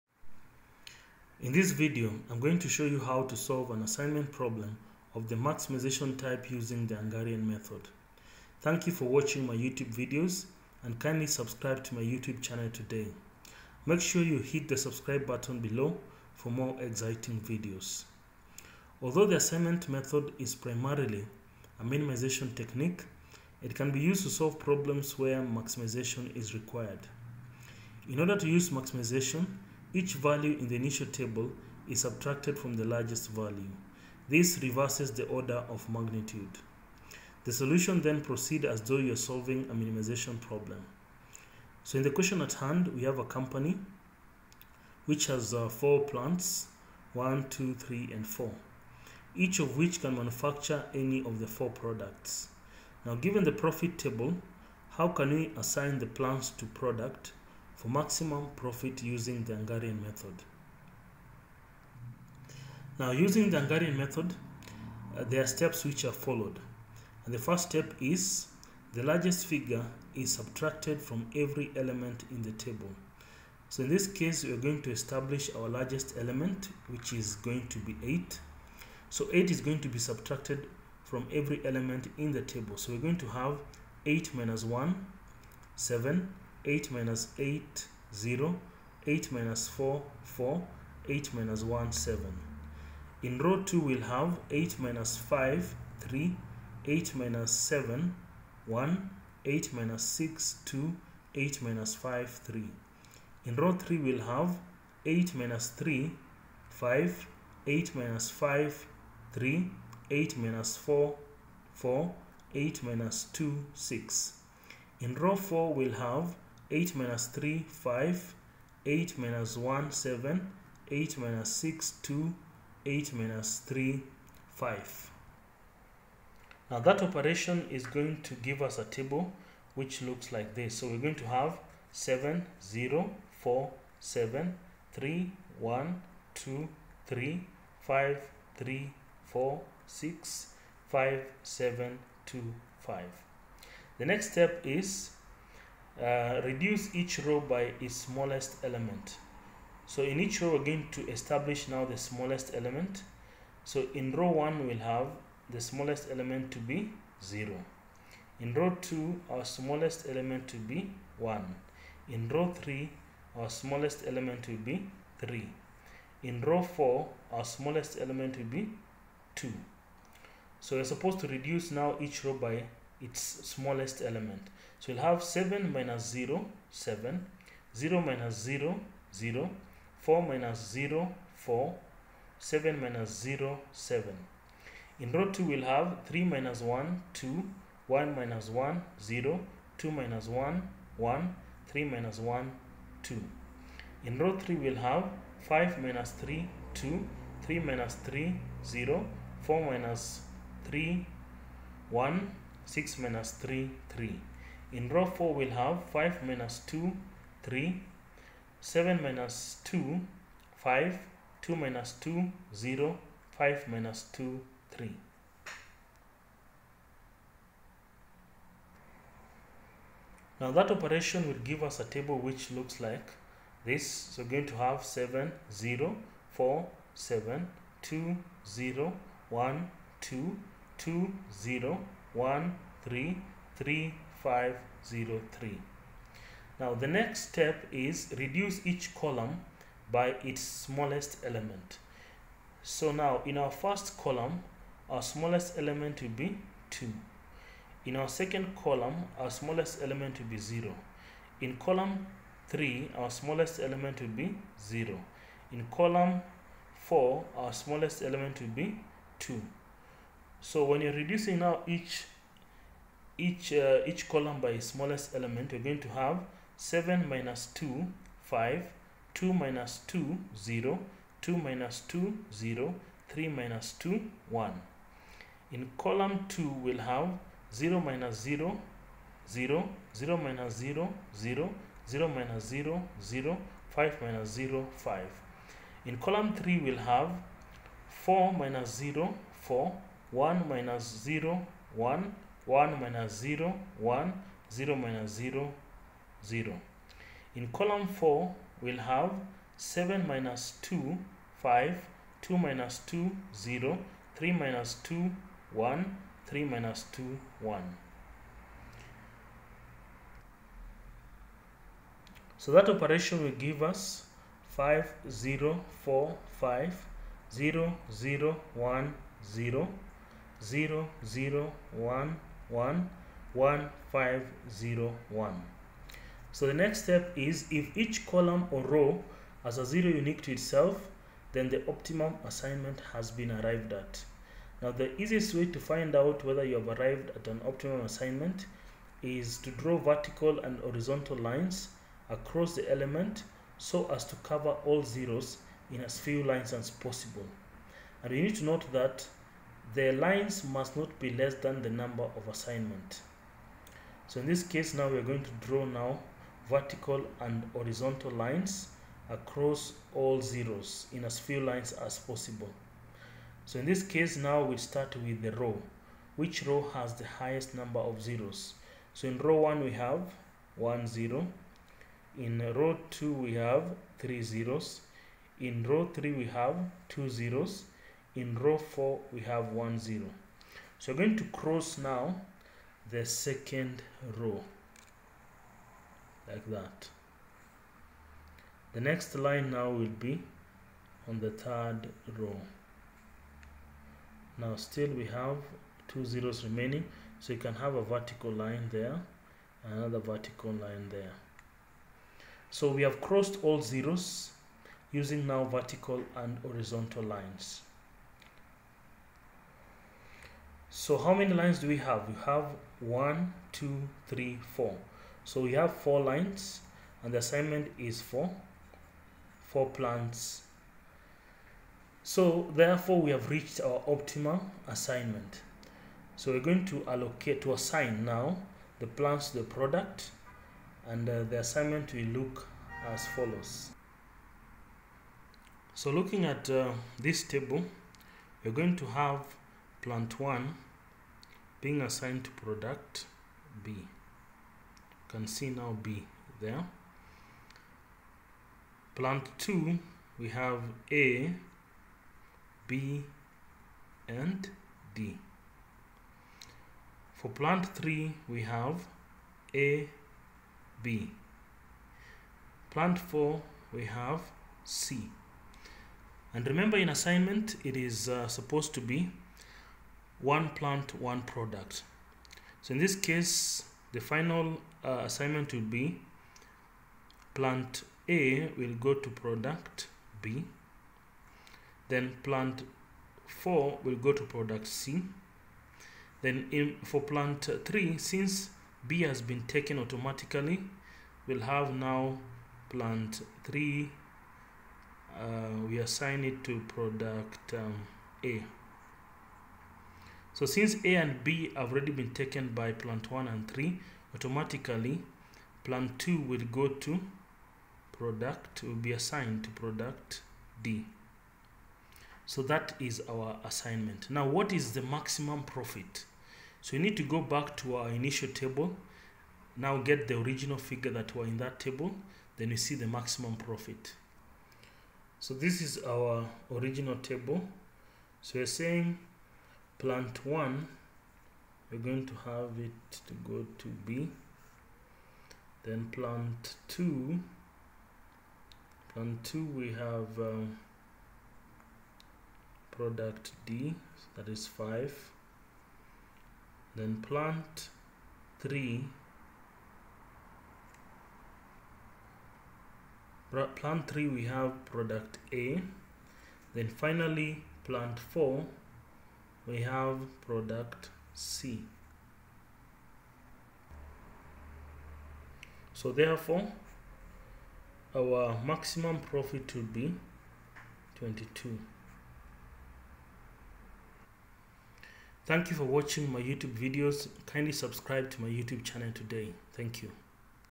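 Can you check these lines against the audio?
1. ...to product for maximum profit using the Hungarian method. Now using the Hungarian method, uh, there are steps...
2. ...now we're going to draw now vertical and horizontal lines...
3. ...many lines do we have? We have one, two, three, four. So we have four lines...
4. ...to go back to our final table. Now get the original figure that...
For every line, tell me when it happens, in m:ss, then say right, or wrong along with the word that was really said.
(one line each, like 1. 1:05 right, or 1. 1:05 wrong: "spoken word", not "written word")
1. 0:56 right
2. 5:54 right
3. 6:51 right
4. 8:36 wrong: "initial", not "final".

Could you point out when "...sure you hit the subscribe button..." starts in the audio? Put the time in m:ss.
0:14.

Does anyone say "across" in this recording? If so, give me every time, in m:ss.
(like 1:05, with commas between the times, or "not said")
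5:42, 5:59.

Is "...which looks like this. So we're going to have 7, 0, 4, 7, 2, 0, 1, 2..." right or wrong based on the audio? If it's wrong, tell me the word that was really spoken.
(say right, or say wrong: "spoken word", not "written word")
right.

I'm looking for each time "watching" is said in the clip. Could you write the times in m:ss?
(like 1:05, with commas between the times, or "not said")
0:09, 9:35.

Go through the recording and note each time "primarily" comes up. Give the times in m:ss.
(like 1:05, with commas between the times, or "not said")
0:20.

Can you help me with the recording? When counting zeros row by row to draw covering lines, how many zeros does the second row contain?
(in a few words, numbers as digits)
3.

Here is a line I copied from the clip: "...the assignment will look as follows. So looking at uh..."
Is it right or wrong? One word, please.
right.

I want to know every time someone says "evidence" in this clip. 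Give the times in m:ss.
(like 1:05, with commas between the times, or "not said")
not said.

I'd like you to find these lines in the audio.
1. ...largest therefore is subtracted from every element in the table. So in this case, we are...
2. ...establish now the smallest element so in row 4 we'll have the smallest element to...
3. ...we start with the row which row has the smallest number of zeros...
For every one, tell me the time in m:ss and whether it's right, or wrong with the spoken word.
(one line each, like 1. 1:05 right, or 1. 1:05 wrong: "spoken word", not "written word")
1. 1:09 wrong: "figure", not "therefore"
2. 2:31 wrong: "1", not "4"
3. 6:04 wrong: "highest", not "smallest".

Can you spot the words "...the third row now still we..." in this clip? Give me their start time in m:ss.
6:31.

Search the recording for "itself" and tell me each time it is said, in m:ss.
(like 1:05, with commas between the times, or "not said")
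5:30.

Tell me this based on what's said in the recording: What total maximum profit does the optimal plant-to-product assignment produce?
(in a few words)
22.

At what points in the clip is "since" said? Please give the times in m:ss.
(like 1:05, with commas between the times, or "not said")
8:07, 8:20.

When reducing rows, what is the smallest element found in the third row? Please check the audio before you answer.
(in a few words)
3.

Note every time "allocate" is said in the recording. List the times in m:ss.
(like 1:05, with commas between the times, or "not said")
7:06.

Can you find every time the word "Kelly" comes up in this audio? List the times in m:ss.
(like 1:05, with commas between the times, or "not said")
not said.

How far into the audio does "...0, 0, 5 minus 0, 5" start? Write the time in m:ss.
4:42.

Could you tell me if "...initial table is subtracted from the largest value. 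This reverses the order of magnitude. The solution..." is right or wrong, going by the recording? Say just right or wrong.
right.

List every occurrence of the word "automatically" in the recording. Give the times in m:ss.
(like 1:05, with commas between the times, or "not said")
8:09, 8:24.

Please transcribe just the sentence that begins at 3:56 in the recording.
Now the next step is reduce each column by its smallest element.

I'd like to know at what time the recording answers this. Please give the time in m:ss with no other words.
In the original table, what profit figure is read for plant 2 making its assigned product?
9:04.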